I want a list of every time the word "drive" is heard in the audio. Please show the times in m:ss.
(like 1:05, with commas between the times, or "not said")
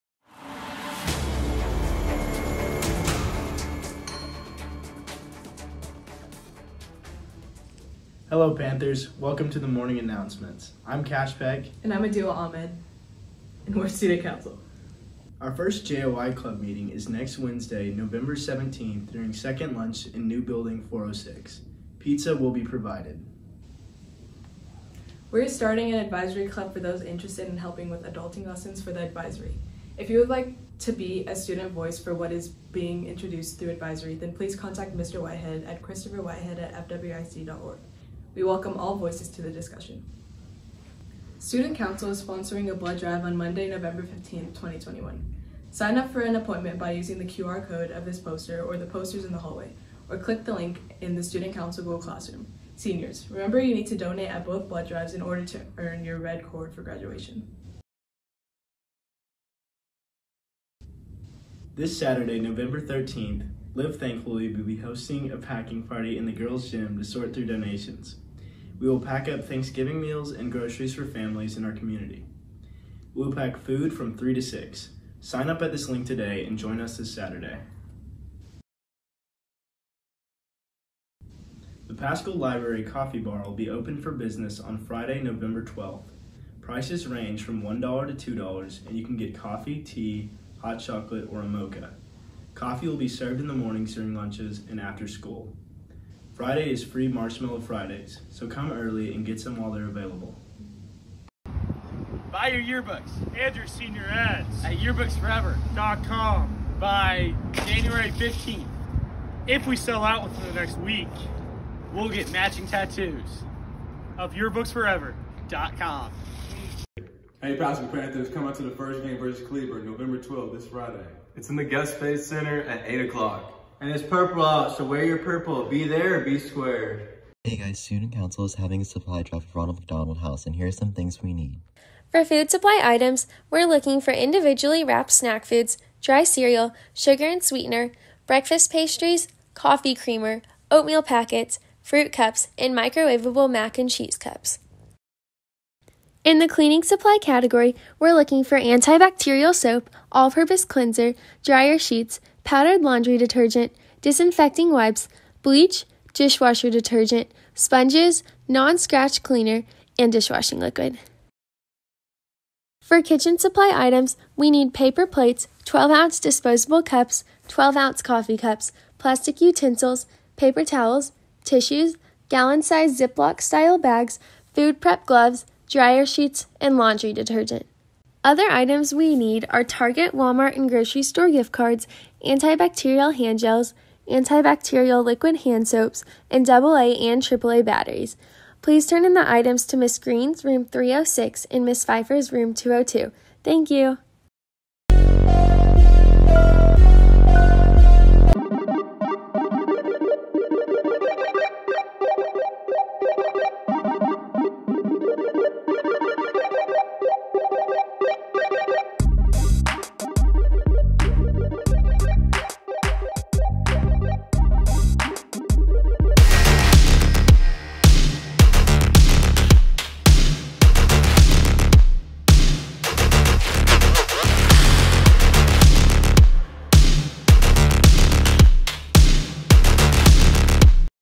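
0:42, 0:54, 2:09.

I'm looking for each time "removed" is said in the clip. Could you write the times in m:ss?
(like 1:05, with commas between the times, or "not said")
not said.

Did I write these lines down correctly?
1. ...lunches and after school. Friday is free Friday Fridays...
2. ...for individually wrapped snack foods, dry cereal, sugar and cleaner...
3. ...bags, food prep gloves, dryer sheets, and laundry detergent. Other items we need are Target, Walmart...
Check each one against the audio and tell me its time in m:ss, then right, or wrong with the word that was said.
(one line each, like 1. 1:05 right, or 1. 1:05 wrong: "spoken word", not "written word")
1. 1:34 wrong: "Marshmallow", not "Friday"
2. 2:14 wrong: "sweetener", not "cleaner"
3. 2:53 right.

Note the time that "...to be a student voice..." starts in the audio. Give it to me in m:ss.
0:30.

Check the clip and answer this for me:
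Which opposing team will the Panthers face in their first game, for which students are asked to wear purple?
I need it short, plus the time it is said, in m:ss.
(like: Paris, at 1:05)
Cleveland, at 1:59.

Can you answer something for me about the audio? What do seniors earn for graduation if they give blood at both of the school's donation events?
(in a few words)
red cord.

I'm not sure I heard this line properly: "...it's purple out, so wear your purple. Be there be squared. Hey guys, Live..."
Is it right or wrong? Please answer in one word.
wrong.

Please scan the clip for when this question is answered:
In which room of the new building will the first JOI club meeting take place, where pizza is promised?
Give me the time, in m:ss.
0:20.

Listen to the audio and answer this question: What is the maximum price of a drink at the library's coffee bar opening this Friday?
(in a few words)
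$2.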